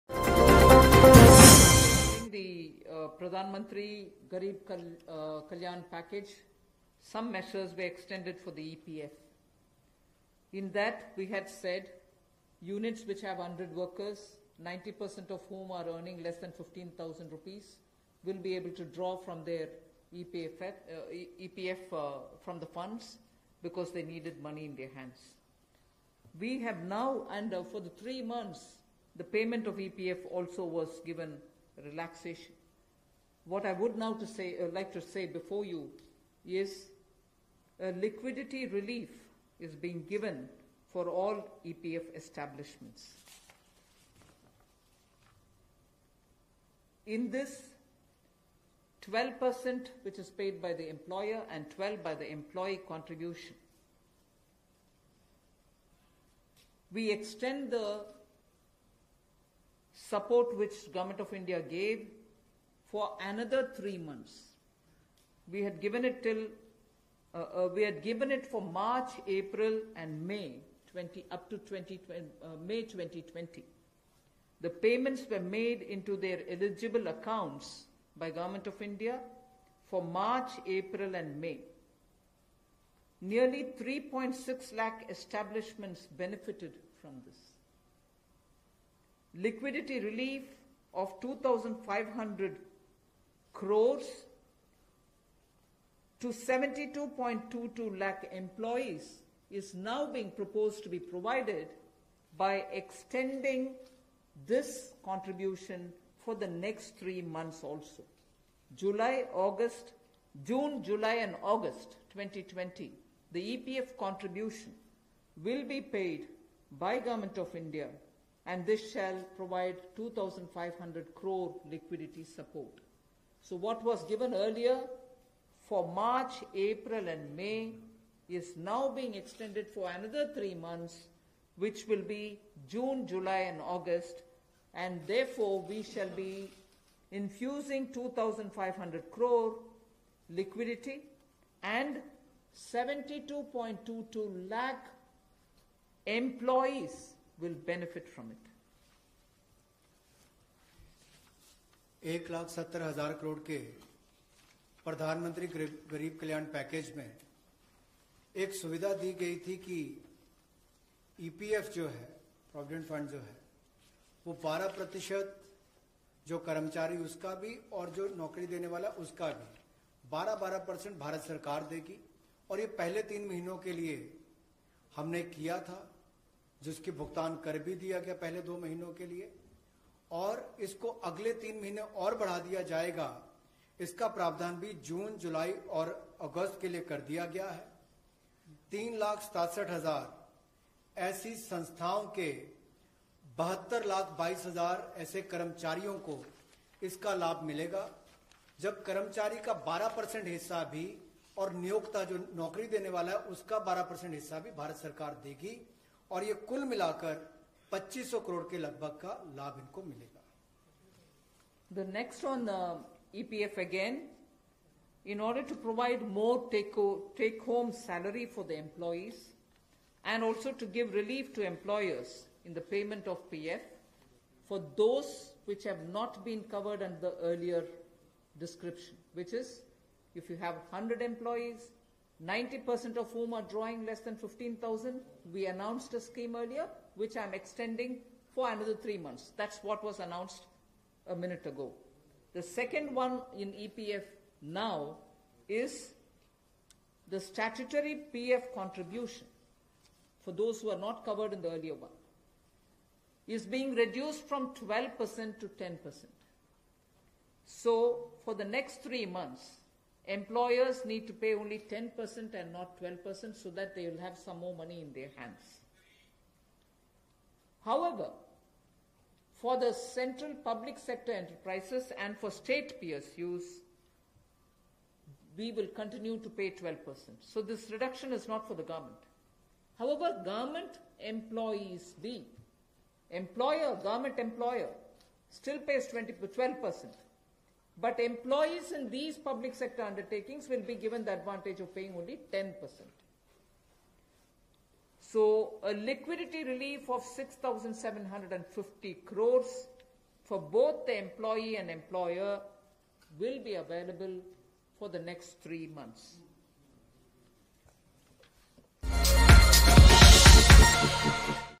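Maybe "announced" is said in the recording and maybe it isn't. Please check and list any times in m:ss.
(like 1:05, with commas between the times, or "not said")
3:55, 3:59.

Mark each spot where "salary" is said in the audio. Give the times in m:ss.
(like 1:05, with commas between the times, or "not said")
3:37.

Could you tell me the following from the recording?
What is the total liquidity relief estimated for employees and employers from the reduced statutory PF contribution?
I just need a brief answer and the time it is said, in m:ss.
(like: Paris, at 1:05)
6,750 crores, at 4:57.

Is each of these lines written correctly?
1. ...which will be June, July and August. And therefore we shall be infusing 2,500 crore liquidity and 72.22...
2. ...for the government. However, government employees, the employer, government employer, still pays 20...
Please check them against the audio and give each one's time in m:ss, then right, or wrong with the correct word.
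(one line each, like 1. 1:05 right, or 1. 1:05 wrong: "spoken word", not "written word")
1. 2:11 right
2. 4:38 right.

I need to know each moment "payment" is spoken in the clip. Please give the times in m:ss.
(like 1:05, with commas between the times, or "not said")
0:29, 1:14, 3:42.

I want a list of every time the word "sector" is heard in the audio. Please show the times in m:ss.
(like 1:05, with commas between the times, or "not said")
4:30, 4:49.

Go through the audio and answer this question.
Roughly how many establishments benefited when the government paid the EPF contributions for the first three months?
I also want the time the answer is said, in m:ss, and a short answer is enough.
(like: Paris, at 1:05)
3.6 lakh, at 1:23.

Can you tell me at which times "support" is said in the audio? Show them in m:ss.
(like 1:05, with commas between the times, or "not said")
0:59, 2:02.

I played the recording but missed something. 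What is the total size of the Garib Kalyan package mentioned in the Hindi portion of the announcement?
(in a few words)
1,70,000 crore.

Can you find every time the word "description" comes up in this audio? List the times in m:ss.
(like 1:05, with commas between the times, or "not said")
3:48.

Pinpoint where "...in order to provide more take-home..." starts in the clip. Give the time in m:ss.
3:35.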